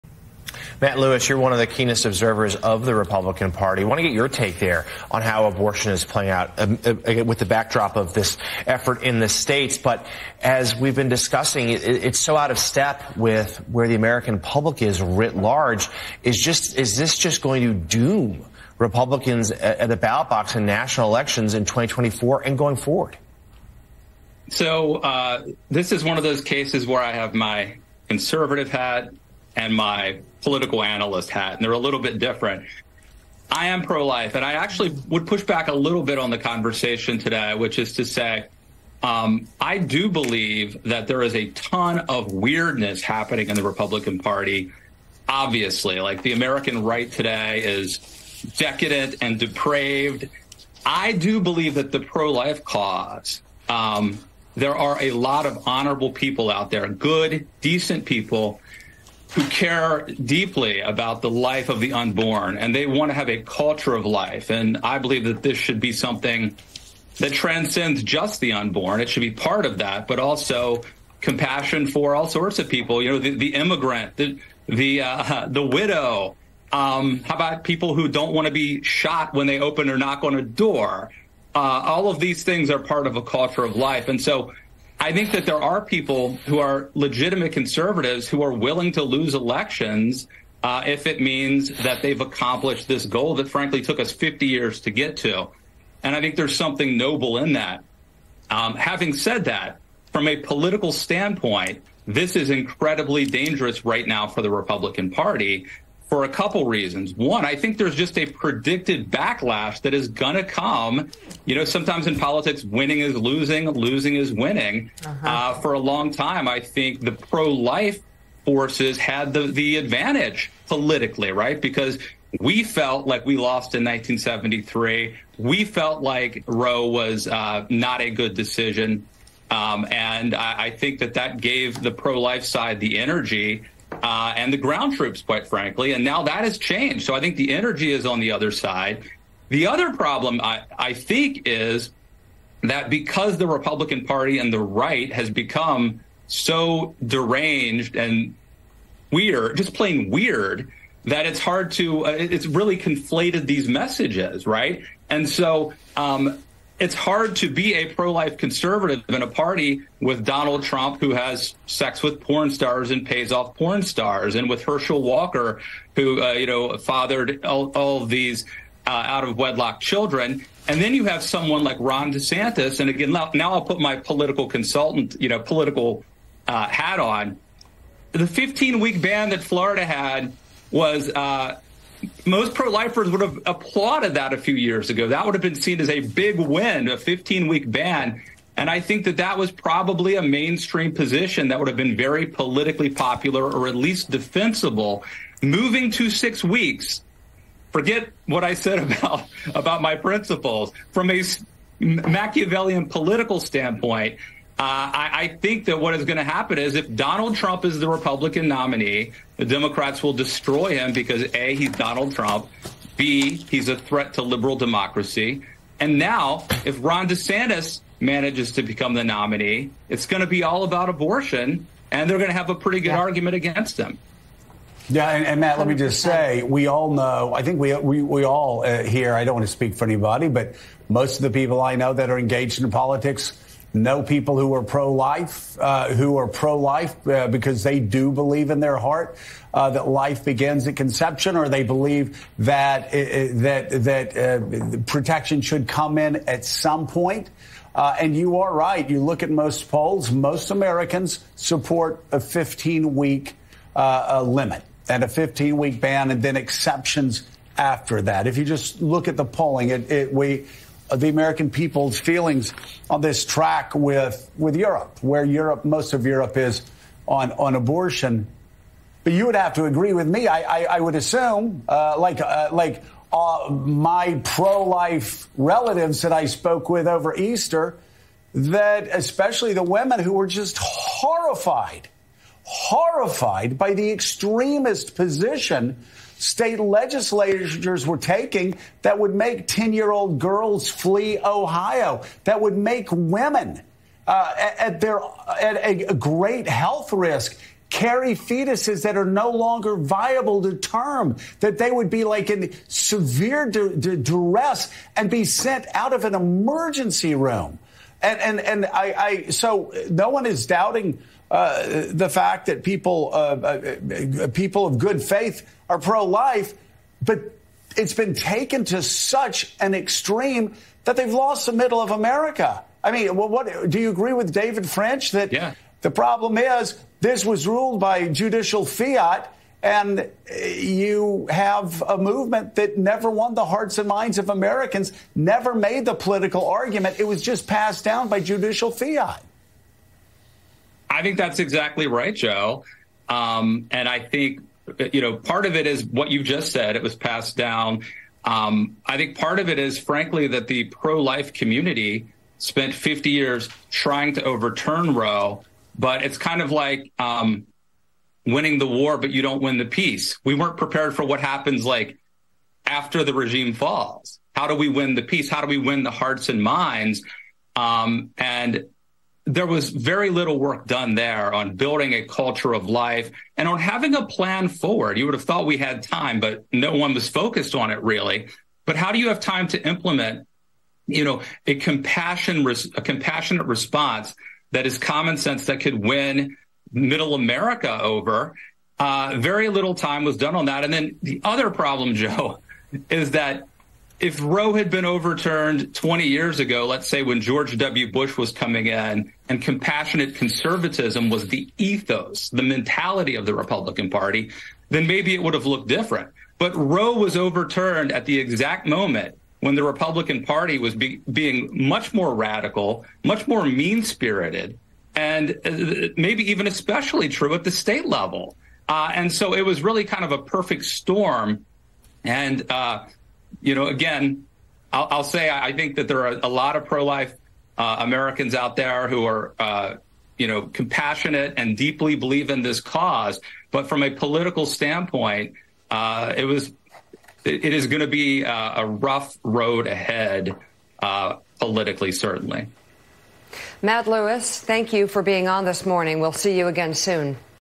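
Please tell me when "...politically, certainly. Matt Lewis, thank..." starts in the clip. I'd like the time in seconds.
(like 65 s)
441 s.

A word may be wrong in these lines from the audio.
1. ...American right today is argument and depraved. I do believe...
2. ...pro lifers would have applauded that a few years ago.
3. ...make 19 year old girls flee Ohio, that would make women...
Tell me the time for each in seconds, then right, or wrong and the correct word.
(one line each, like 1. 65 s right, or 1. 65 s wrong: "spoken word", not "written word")
1. 46 s wrong: "decadent", not "argument"
2. 182 s right
3. 289 s wrong: "10", not "19".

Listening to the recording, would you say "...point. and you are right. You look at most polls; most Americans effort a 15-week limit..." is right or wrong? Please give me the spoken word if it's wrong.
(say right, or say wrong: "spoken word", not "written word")
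wrong: "support", not "effort".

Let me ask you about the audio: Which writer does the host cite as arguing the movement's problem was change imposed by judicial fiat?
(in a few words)
David French.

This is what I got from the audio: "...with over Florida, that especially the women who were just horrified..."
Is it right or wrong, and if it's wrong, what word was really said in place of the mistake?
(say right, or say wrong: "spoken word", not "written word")
wrong: "Easter", not "Florida".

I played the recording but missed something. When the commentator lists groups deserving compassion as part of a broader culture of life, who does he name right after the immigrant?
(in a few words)
the widow.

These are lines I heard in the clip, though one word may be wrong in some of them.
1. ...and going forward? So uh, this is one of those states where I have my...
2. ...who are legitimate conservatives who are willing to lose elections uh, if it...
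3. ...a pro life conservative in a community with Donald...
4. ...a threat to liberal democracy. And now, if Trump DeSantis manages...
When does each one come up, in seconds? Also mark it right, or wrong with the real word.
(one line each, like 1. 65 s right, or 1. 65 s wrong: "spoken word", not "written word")
1. 22 s wrong: "cases", not "states"
2. 86 s right
3. 157 s wrong: "party", not "community"
4. 213 s wrong: "Ron", not "Trump".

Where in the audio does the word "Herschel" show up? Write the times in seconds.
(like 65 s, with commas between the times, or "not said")
164 s.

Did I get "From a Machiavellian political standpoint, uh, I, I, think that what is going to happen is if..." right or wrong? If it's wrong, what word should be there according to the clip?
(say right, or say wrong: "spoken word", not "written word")
right.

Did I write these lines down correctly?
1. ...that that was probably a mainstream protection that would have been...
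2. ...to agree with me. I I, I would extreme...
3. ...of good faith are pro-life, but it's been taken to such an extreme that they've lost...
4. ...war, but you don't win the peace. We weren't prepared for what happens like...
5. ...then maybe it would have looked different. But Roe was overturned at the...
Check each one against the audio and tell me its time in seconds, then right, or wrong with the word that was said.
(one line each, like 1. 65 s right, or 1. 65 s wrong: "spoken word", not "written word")
1. 189 s wrong: "position", not "protection"
2. 269 s wrong: "assume", not "extreme"
3. 314 s right
4. 358 s right
5. 404 s right.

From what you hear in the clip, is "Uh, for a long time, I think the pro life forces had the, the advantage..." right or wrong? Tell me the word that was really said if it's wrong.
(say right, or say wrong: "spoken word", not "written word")
right.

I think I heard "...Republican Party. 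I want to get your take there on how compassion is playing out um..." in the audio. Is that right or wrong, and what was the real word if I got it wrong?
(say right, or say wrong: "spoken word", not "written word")
wrong: "abortion", not "compassion".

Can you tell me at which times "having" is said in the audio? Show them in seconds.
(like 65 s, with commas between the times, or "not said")
98 s, 373 s.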